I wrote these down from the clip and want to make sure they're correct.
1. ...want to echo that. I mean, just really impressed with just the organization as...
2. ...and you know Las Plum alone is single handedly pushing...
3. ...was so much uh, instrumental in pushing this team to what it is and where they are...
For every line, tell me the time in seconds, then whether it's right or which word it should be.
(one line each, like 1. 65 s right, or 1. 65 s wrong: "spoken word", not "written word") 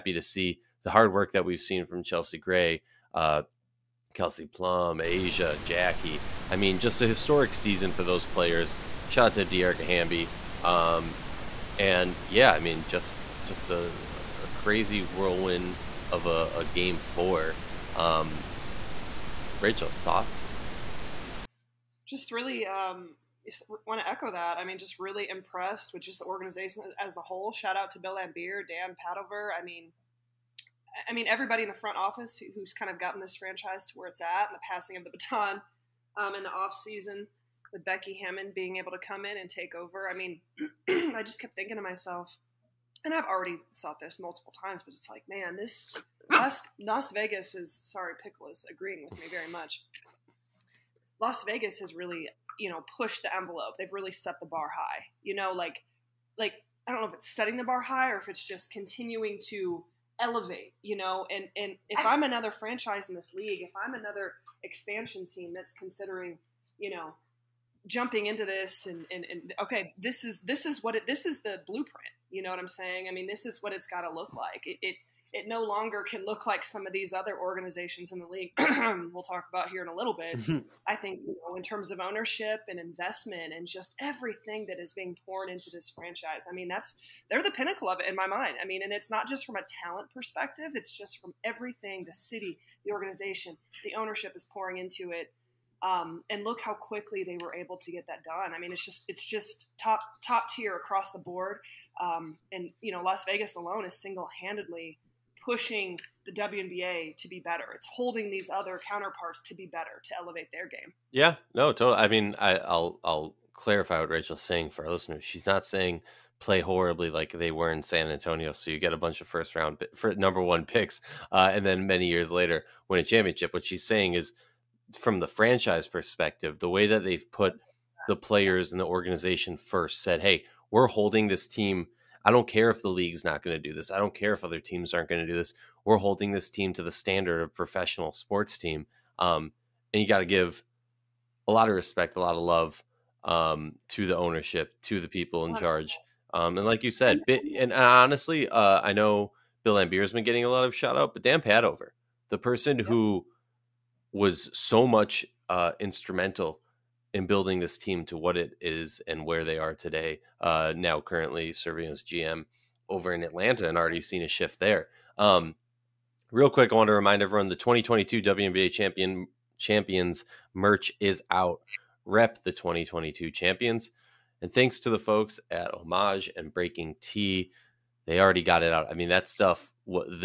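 1. 23 s right
2. 102 s wrong: "Vegas", not "Plum"
3. 154 s wrong: "building", not "pushing".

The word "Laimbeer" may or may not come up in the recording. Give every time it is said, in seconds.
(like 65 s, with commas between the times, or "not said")
28 s, 149 s.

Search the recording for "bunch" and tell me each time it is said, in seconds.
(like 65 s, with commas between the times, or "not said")
118 s.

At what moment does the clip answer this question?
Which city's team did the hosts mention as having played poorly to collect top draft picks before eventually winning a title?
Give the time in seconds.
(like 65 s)
117 s.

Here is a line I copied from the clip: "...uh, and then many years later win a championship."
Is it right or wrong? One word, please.
right.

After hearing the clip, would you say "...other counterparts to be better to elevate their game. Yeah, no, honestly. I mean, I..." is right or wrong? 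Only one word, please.
wrong.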